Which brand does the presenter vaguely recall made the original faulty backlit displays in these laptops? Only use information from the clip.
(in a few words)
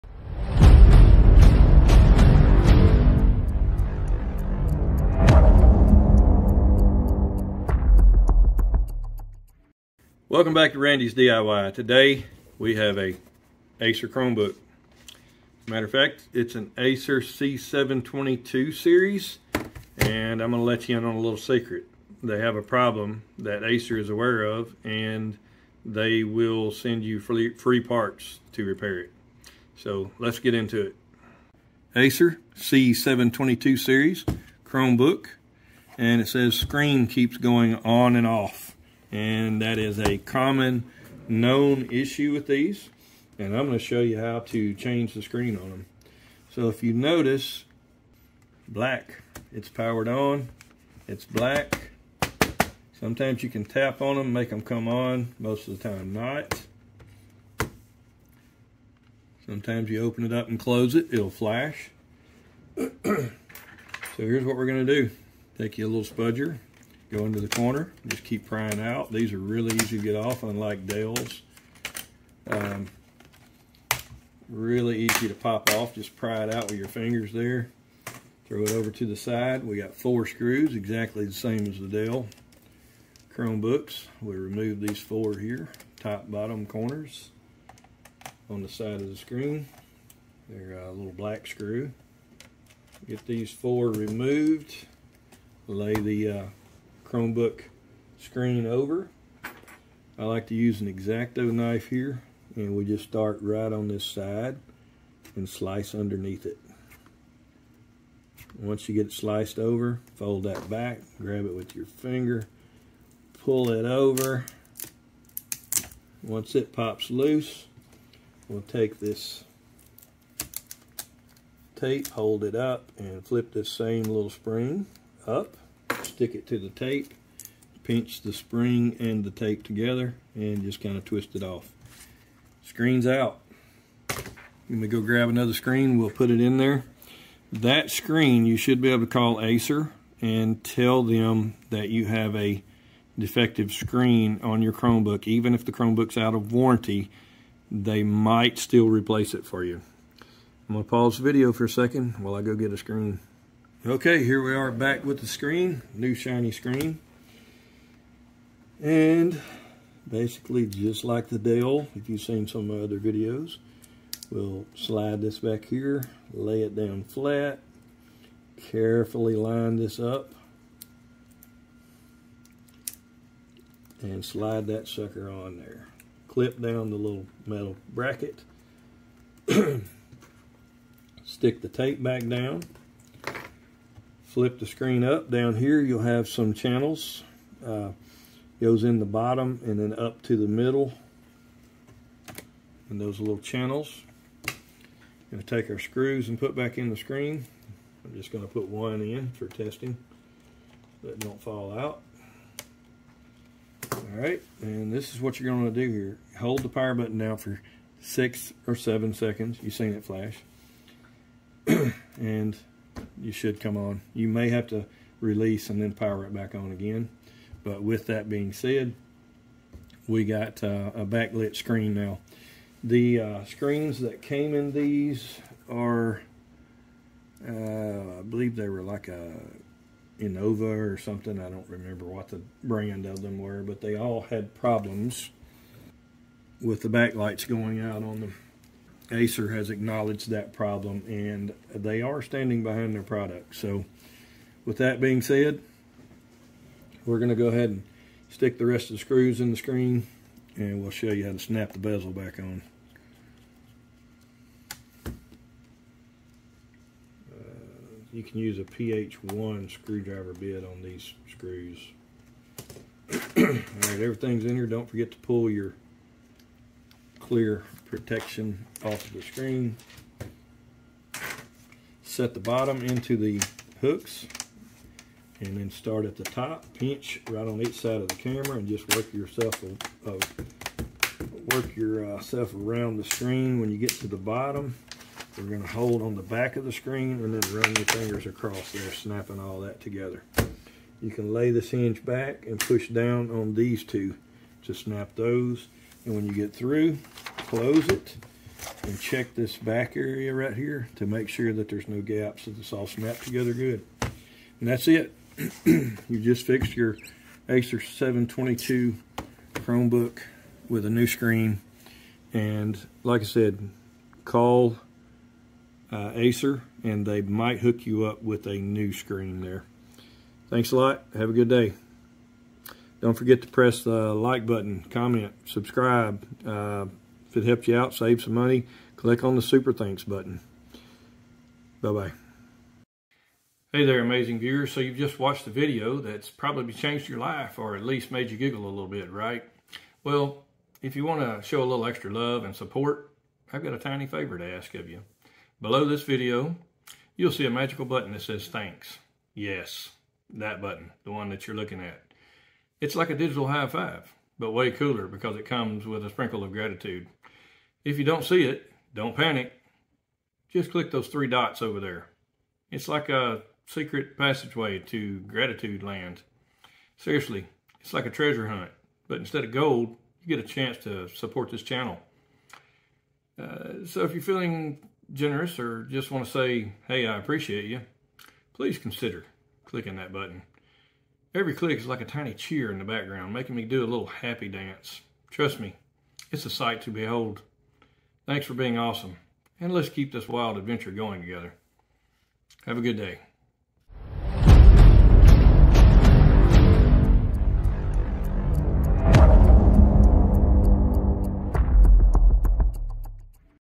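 Innova.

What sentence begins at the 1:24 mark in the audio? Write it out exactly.
We remove these four here, top, bottom corners on the side of the screen.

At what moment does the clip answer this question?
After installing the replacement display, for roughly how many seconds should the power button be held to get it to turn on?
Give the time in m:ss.
3:27.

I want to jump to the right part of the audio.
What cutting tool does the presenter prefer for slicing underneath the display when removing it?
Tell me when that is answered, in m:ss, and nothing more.
1:40.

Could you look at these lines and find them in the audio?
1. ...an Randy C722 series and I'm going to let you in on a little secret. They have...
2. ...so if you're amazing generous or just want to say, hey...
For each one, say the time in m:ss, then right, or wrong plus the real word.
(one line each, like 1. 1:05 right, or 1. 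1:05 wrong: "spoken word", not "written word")
1. 0:16 wrong: "Acer", not "Randy"
2. 6:13 wrong: "feeling", not "amazing".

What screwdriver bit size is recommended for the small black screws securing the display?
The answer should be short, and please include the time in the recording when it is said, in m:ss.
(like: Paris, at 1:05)
PH1, at 4:18.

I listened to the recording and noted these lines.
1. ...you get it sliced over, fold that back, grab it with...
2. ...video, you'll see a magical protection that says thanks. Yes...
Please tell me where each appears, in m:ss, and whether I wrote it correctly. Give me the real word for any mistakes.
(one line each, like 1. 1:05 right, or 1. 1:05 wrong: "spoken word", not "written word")
1. 1:48 right
2. 5:46 wrong: "button", not "protection".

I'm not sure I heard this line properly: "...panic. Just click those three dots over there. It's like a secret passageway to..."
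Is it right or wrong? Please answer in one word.
right.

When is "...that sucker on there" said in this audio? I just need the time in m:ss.
2:54.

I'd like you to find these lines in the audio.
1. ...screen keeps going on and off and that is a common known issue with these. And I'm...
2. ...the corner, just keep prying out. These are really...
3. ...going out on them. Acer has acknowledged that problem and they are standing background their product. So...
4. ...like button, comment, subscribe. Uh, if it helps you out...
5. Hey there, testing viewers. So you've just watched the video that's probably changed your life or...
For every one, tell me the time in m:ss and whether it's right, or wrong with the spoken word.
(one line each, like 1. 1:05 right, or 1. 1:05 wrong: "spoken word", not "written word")
1. 0:36 right
2. 1:07 right
3. 3:57 wrong: "behind", not "background"
4. 5:24 right
5. 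5:33 wrong: "amazing", not "testing".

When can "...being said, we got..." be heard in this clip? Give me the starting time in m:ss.
3:38.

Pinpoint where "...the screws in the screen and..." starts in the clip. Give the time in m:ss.
4:08.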